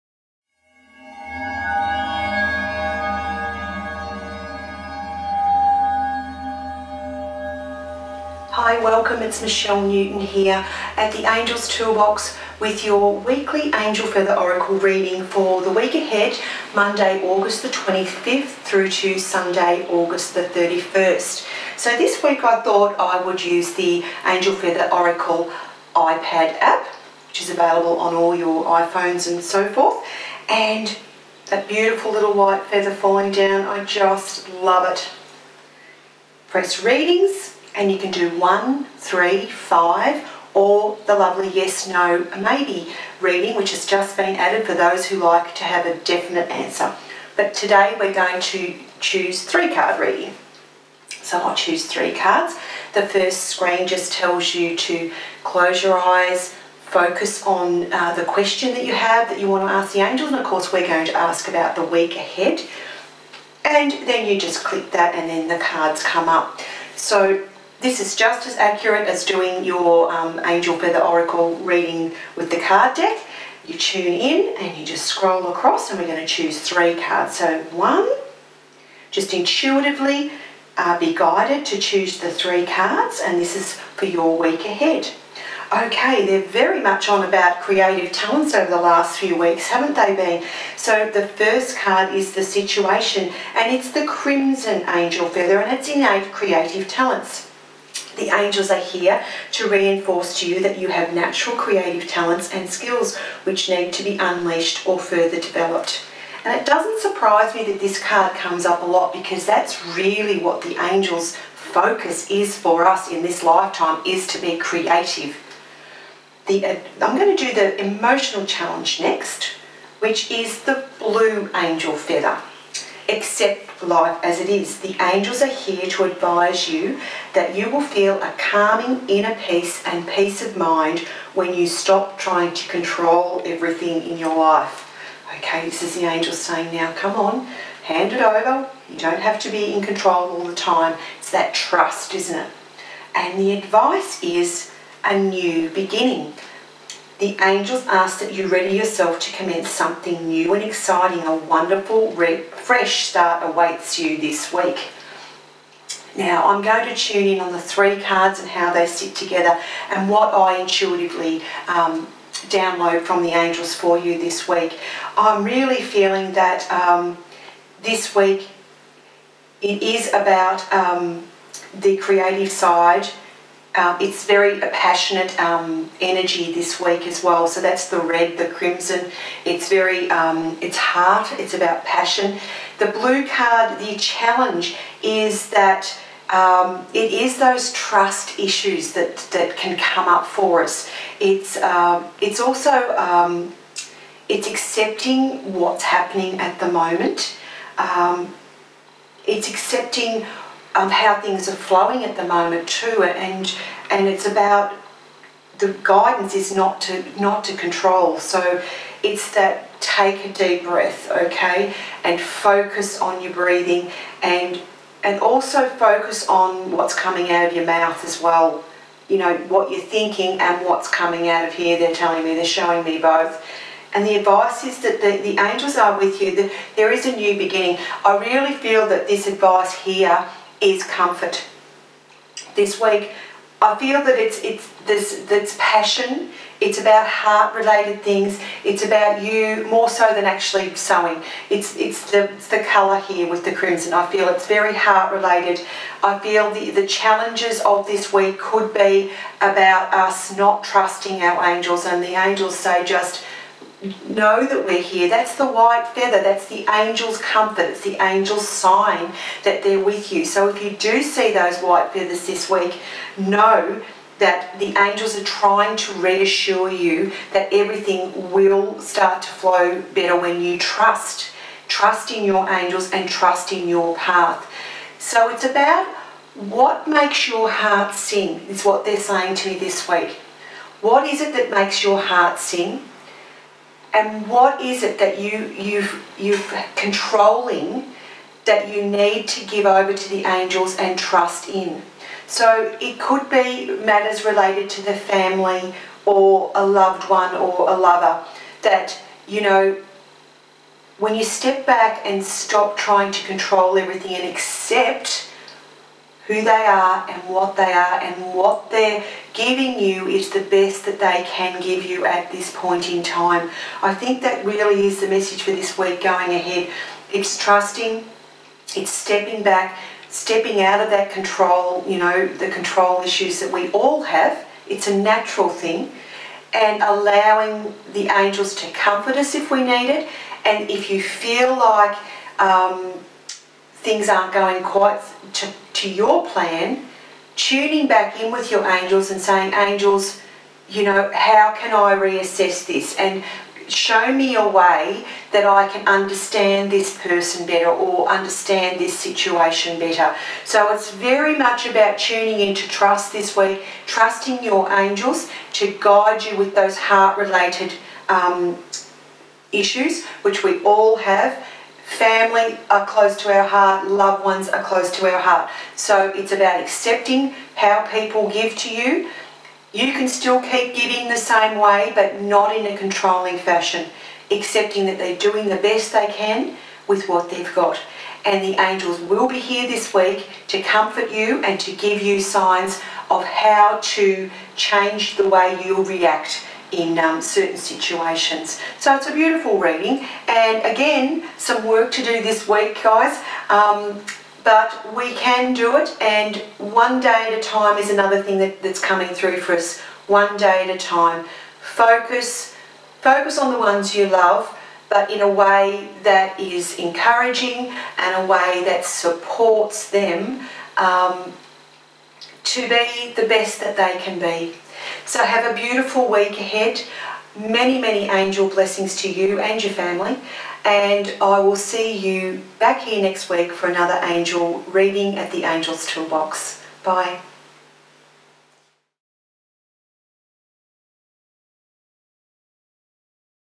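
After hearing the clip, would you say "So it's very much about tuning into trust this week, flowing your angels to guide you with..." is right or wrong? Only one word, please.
wrong.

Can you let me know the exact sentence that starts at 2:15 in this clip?
Okay, this is the angel saying now, come on, hand it over.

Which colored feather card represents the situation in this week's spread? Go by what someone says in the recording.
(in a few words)
Crimson Angel Feather.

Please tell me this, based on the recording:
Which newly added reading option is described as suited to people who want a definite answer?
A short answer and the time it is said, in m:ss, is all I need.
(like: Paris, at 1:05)
yes, no, maybe reading, at 0:41.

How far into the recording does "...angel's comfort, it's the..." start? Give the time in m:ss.
4:16.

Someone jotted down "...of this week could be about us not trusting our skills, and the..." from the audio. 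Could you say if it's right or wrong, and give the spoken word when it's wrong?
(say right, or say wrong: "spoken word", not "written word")
wrong: "angels", not "skills".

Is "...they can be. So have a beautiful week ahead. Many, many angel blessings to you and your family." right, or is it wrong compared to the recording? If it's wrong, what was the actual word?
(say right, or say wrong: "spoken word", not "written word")
right.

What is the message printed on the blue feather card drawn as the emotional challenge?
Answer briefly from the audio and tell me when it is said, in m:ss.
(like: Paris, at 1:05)
Accept life as it is, at 2:03.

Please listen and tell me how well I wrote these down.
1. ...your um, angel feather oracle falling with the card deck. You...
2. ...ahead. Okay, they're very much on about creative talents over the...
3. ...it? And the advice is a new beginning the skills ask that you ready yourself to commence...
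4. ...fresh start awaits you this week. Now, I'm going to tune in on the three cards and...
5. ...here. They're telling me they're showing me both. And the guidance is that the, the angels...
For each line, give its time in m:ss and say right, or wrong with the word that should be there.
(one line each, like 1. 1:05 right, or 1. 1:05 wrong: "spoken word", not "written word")
1. 1:09 wrong: "reading", not "falling"
2. 1:24 right
3. 2:22 wrong: "angels", not "skills"
4. 2:32 right
5. 3:41 wrong: "advice", not "guidance".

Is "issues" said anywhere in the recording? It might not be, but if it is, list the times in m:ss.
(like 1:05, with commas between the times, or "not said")
3:08, 5:23, 5:59.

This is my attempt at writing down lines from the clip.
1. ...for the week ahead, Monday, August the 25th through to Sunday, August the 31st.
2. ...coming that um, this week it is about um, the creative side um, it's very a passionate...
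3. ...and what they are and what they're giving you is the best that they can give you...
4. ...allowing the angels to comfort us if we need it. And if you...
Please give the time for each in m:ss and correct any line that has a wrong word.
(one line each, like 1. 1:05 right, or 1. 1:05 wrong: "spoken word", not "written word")
1. 0:15 right
2. 2:45 wrong: "feeling", not "coming"
3. 5:07 right
4. 5:26 right.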